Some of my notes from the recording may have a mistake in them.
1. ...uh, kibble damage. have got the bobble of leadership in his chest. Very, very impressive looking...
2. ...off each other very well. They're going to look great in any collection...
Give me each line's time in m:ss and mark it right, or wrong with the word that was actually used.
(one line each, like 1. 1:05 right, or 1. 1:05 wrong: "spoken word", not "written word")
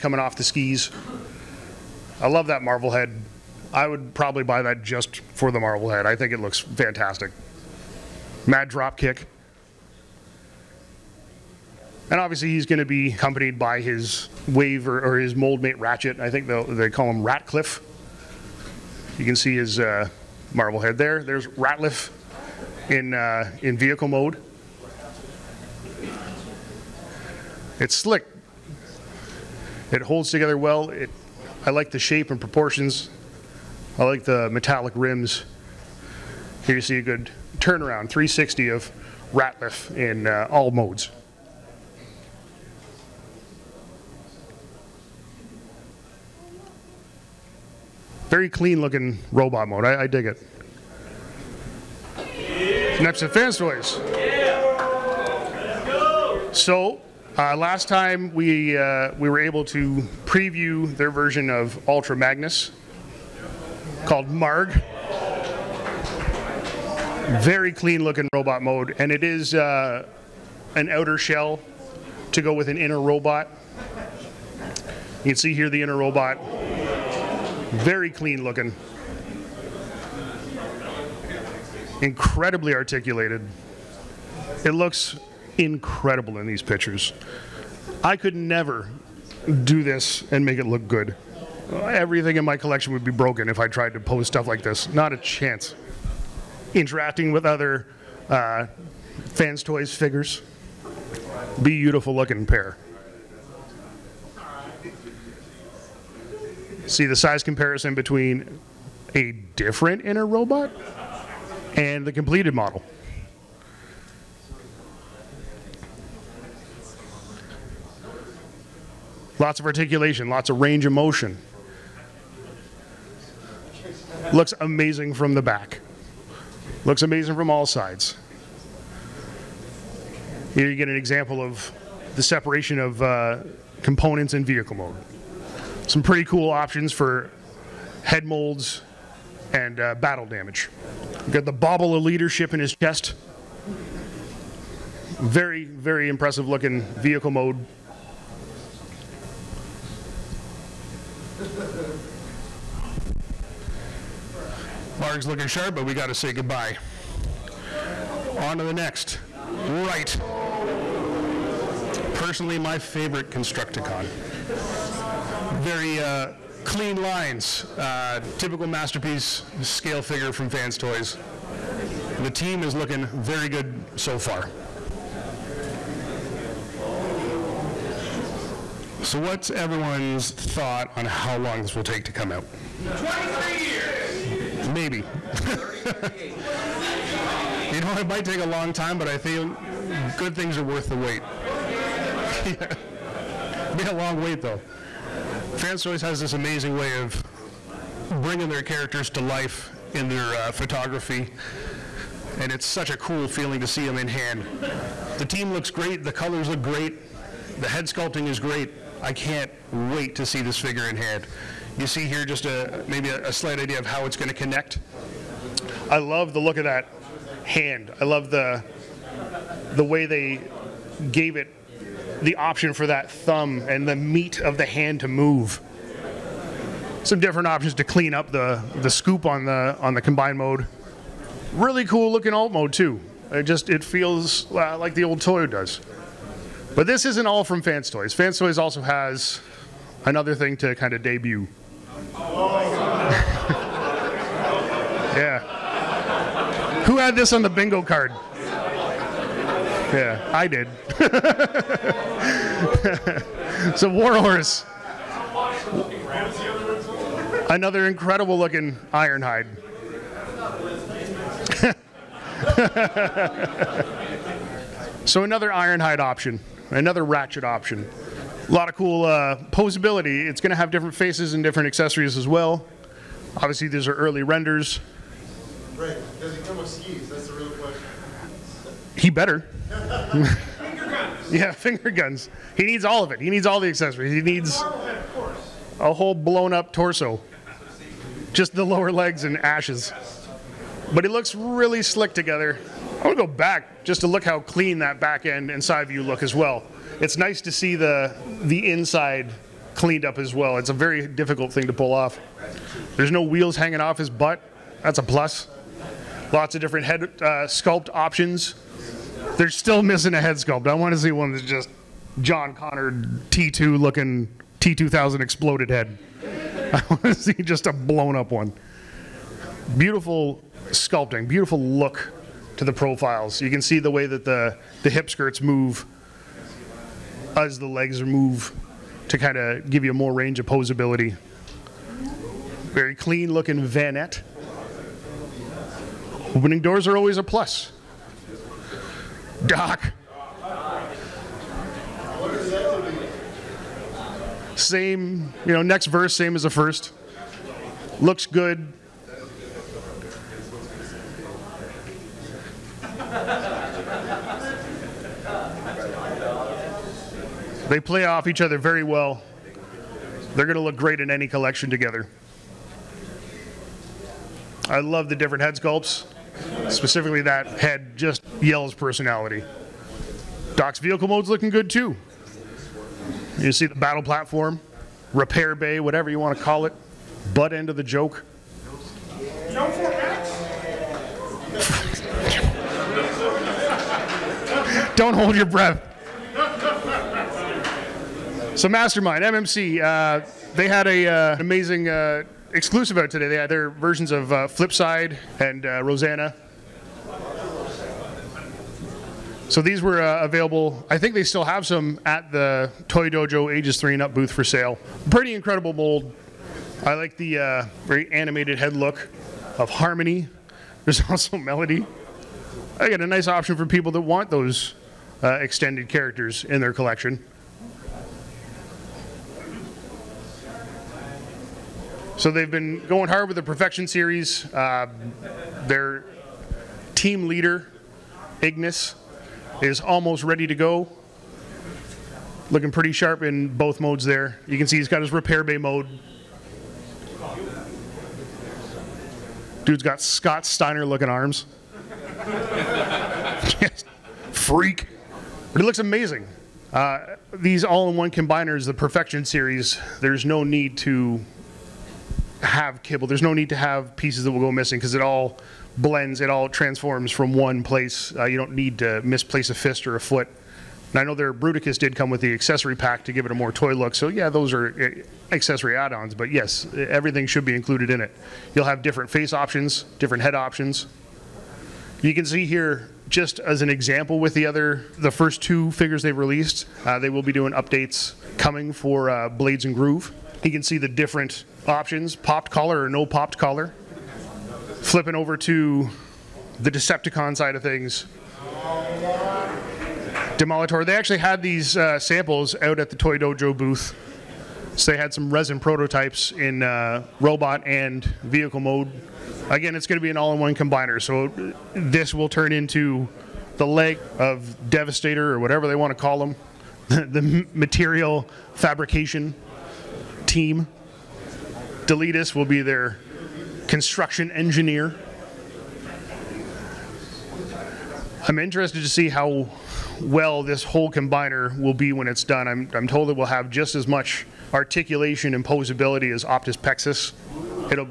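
1. 2:19 wrong: "battle", not "kibble"
2. 5:58 right.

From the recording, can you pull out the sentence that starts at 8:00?
He can see the different options, popped collar or no popped collar.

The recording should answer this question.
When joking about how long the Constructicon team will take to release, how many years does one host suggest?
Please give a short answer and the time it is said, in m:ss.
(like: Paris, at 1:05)
23 years, at 3:02.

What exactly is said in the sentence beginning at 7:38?
Uh, you don't need to misplace a fist or a foot.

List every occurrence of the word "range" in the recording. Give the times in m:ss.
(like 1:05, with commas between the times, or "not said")
2:00, 5:30.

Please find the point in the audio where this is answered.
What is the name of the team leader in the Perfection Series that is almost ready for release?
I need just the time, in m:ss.
7:08.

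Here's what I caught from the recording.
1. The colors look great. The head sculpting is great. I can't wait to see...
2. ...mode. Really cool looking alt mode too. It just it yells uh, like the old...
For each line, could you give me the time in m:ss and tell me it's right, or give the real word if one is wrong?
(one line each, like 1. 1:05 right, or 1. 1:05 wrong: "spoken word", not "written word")
1. 3:26 right
2. 3:50 wrong: "feels", not "yells".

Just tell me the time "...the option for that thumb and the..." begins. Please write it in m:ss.
3:42.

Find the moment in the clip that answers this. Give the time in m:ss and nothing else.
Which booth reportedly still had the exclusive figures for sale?
6:42.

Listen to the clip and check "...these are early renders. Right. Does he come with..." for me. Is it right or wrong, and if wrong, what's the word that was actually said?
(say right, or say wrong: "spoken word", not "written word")
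right.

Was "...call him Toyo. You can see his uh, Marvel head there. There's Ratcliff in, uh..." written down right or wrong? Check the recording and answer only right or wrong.
wrong.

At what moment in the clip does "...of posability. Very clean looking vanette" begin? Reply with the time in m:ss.
5:30.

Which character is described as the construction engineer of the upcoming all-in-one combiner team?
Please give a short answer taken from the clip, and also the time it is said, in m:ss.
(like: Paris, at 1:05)
Deletus, at 8:31.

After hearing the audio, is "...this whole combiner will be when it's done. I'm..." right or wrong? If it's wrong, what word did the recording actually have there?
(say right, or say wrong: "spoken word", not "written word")
right.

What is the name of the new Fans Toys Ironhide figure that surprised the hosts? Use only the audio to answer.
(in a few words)
Warhorse.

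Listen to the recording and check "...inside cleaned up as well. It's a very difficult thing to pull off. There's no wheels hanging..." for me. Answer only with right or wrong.
right.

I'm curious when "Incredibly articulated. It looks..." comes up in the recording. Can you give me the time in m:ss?
1:22.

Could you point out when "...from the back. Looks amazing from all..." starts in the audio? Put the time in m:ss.
2:05.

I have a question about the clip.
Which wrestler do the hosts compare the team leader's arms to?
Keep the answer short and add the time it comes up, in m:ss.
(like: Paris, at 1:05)
Scott Steiner, at 7:20.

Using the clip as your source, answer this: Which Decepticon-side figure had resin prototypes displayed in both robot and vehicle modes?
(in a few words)
Demolitor.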